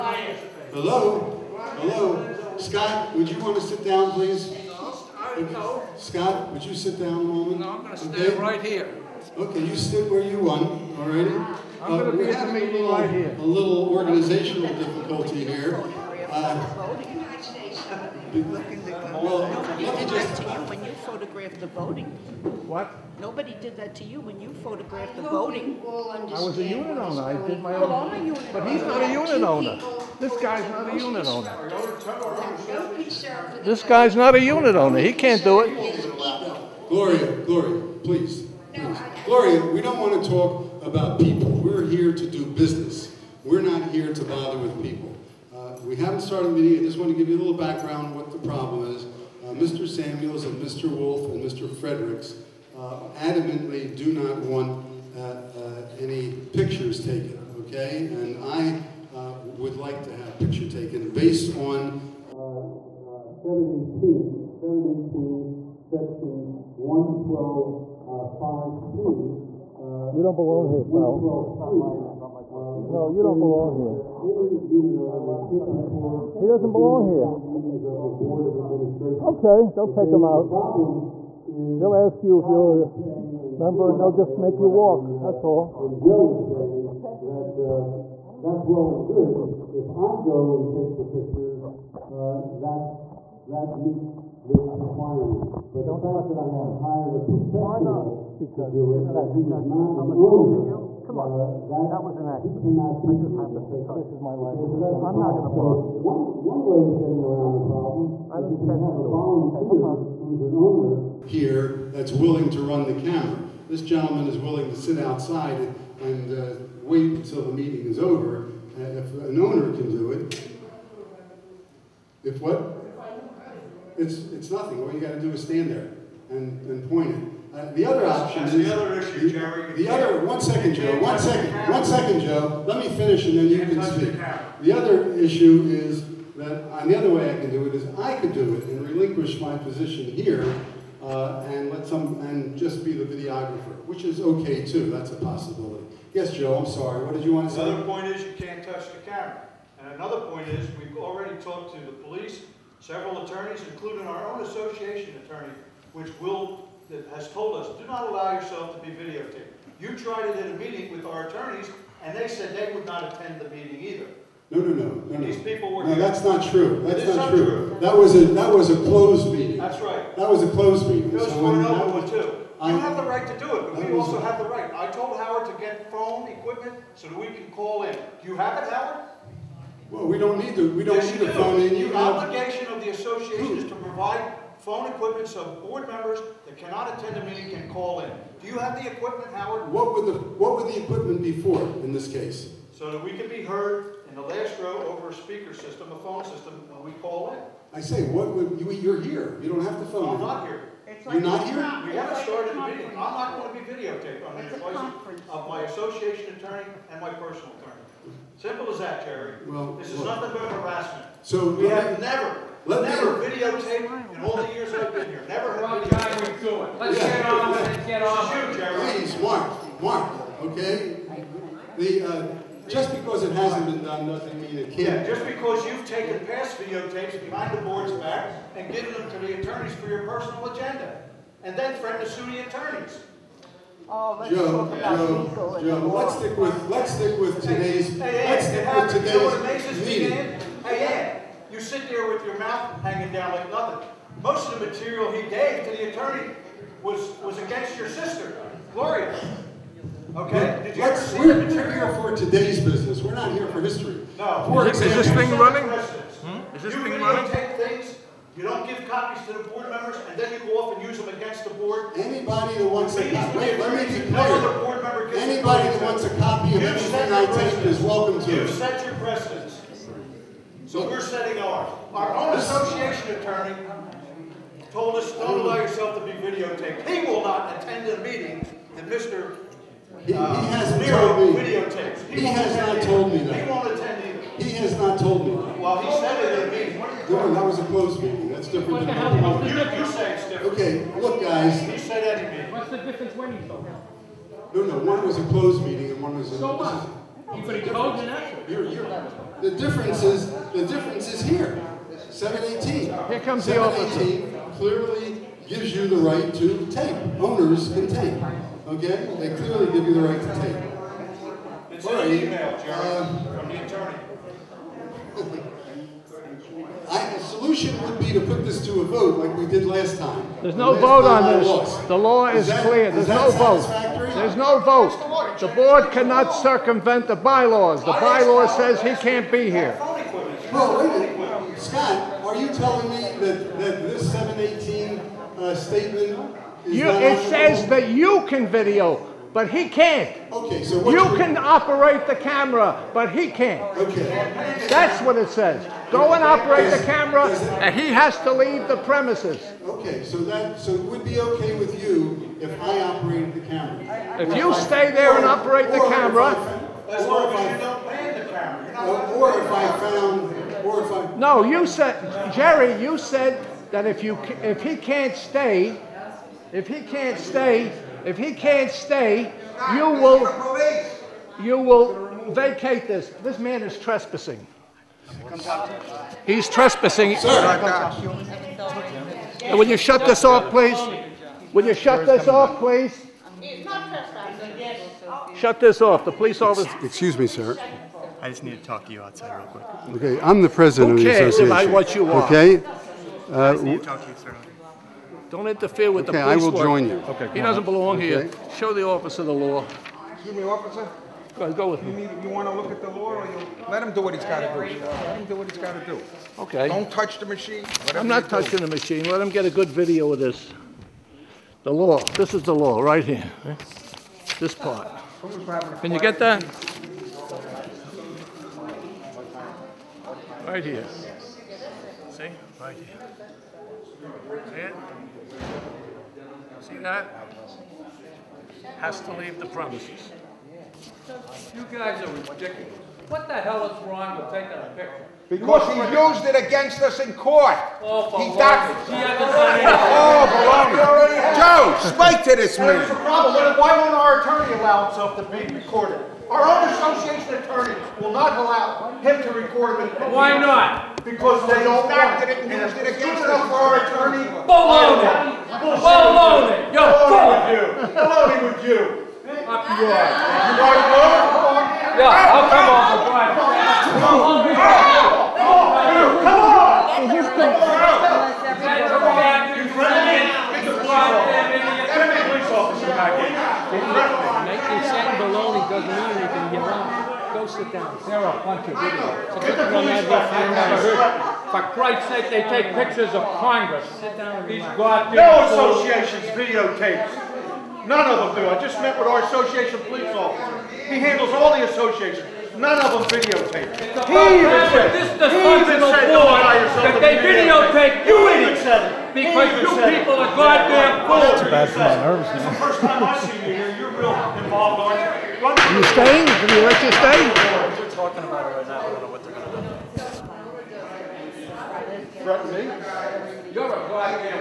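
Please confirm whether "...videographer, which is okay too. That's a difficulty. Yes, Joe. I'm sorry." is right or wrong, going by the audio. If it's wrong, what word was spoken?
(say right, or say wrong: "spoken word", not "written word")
wrong: "possibility", not "difficulty".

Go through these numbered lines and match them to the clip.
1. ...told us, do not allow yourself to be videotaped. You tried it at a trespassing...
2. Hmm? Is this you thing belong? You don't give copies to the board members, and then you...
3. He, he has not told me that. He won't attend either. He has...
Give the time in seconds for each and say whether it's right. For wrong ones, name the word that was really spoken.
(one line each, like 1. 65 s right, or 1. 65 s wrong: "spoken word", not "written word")
1. 157 s wrong: "meeting", not "trespassing"
2. 255 s wrong: "running", not "belong"
3. 282 s right.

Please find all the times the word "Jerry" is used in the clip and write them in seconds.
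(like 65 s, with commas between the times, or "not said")
129 s, 209 s, 218 s, 312 s, 362 s.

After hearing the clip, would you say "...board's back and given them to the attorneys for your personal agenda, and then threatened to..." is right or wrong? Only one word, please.
right.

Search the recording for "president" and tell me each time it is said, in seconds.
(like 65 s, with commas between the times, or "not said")
390 s.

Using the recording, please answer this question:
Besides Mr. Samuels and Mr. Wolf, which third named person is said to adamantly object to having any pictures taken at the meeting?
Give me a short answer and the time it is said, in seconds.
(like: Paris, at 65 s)
Mr. Fredericks, at 51 s.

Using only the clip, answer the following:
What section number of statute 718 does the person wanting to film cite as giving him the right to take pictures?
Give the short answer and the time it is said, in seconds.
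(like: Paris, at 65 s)
Section 112 5C, at 65 s.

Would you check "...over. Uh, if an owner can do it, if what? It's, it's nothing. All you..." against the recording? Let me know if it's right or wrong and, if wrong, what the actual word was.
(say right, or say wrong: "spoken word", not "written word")
right.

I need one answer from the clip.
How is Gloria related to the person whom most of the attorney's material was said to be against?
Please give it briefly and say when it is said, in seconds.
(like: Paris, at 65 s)
Sister, at 247 s.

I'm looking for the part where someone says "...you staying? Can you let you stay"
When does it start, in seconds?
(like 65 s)
505 s.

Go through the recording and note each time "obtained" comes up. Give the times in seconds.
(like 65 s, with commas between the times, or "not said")
not said.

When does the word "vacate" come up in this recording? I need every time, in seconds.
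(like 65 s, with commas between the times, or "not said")
372 s.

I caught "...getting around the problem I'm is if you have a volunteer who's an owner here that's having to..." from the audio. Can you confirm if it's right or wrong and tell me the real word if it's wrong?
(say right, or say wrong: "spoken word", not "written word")
wrong: "willing", not "having".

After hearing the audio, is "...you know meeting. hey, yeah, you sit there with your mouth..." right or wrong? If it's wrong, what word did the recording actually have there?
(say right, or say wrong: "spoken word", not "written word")
right.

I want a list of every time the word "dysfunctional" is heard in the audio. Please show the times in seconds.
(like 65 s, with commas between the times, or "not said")
495 s.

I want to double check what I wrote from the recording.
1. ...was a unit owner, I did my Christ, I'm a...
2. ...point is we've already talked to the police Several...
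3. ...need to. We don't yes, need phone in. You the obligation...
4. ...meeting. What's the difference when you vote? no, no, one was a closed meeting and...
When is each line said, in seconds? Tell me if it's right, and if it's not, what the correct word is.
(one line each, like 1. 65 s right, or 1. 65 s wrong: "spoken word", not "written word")
1. 26 s wrong: "Well", not "Christ"
2. 150 s right
3. 180 s right
4. 292 s right.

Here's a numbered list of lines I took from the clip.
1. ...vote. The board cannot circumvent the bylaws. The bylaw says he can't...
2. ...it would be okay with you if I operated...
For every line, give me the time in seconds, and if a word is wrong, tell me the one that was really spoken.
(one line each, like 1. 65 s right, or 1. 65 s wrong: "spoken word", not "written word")
1. 324 s right
2. 350 s right.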